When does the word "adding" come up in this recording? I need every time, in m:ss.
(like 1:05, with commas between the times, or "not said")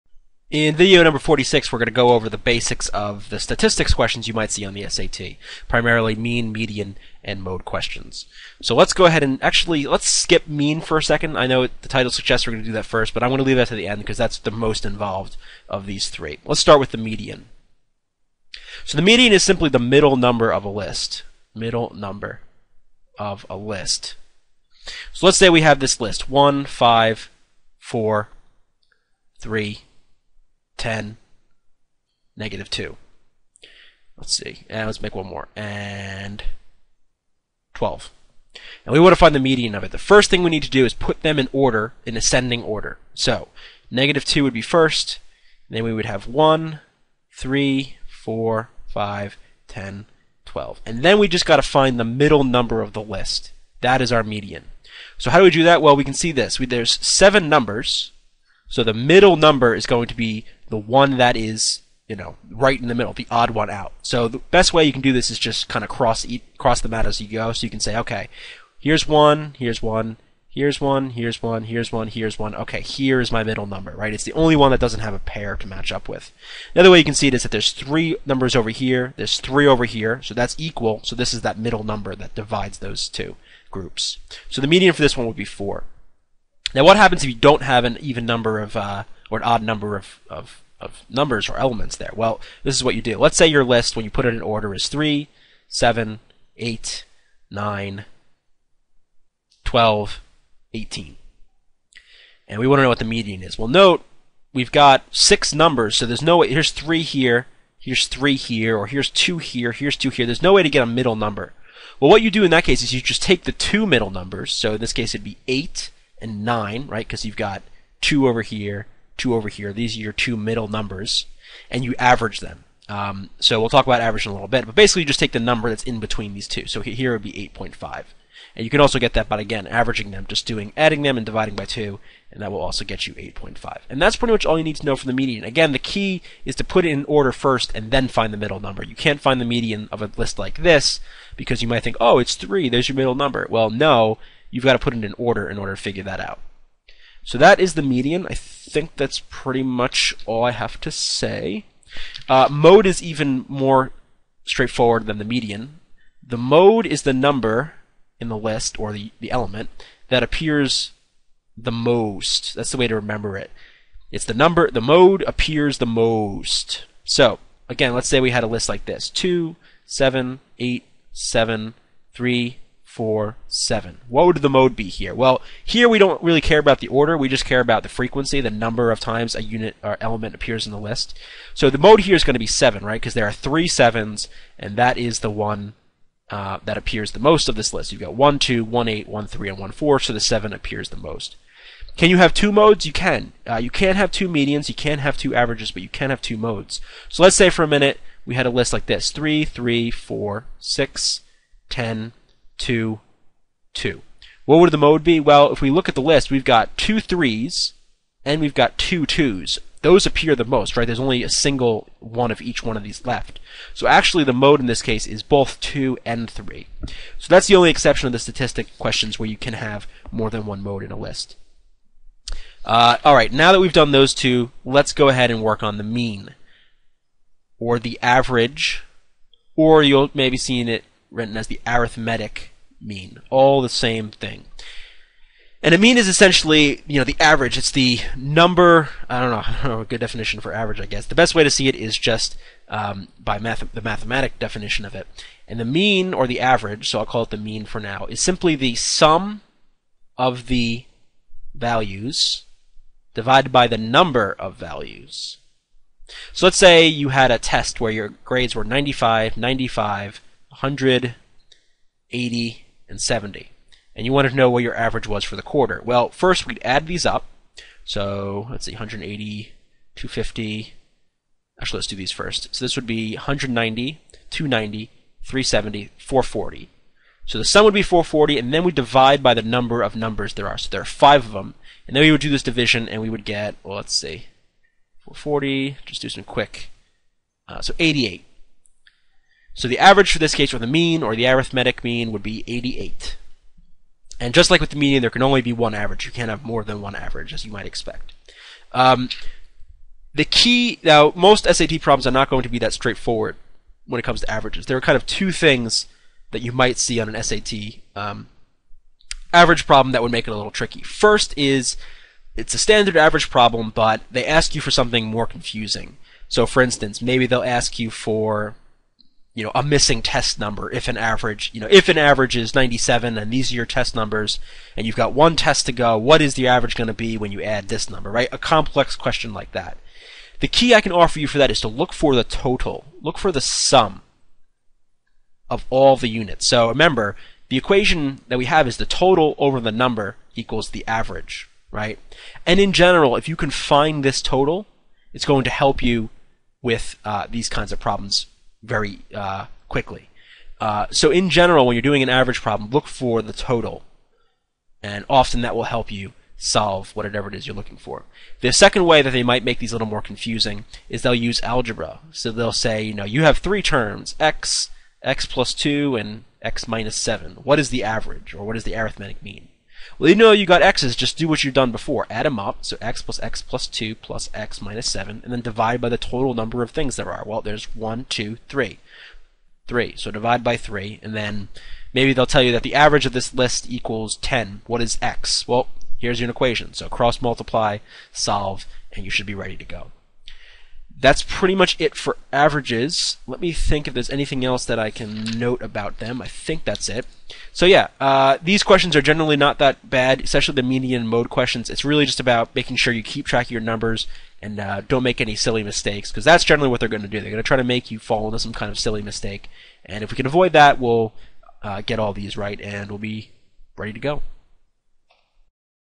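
2:10.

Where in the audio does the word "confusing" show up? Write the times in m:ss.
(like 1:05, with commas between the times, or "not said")
5:15, 6:00.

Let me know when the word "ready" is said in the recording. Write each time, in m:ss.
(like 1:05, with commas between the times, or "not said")
6:29, 6:53.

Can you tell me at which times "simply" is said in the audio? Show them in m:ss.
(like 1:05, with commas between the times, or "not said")
0:19, 4:08.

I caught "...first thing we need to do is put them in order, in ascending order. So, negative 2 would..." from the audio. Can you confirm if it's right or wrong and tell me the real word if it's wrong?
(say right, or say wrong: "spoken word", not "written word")
right.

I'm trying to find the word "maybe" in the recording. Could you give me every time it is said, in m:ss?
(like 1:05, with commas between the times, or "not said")
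3:50, 5:17, 6:21.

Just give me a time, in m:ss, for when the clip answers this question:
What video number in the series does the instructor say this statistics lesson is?
0:01.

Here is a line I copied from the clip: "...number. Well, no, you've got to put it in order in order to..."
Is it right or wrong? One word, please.
right.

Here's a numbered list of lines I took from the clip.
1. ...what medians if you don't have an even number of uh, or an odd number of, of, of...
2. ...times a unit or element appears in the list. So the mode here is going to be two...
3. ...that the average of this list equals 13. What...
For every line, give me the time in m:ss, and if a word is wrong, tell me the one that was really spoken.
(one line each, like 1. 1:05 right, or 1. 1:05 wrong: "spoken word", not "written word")
1. 1:26 wrong: "happens", not "medians"
2. 2:58 wrong: "seven", not "two"
3. 6:22 wrong: "10", not "13".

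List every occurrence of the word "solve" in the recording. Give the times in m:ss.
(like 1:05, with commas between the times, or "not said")
5:56, 6:28.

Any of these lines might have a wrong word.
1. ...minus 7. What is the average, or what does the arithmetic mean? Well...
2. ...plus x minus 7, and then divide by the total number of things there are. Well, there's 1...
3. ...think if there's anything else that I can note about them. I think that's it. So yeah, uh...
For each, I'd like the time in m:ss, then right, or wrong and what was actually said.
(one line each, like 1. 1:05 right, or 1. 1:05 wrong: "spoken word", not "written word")
1. 6:06 right
2. 6:13 right
3. 6:33 right.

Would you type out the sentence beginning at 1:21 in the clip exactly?
So this is that middle number that divides those two groups.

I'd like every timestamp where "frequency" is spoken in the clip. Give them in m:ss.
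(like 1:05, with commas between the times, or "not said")
2:57.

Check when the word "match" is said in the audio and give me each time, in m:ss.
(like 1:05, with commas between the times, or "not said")
1:15.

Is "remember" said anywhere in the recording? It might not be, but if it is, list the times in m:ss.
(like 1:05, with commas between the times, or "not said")
2:42, 5:36.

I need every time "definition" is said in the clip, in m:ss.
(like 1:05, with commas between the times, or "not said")
3:59, 4:04.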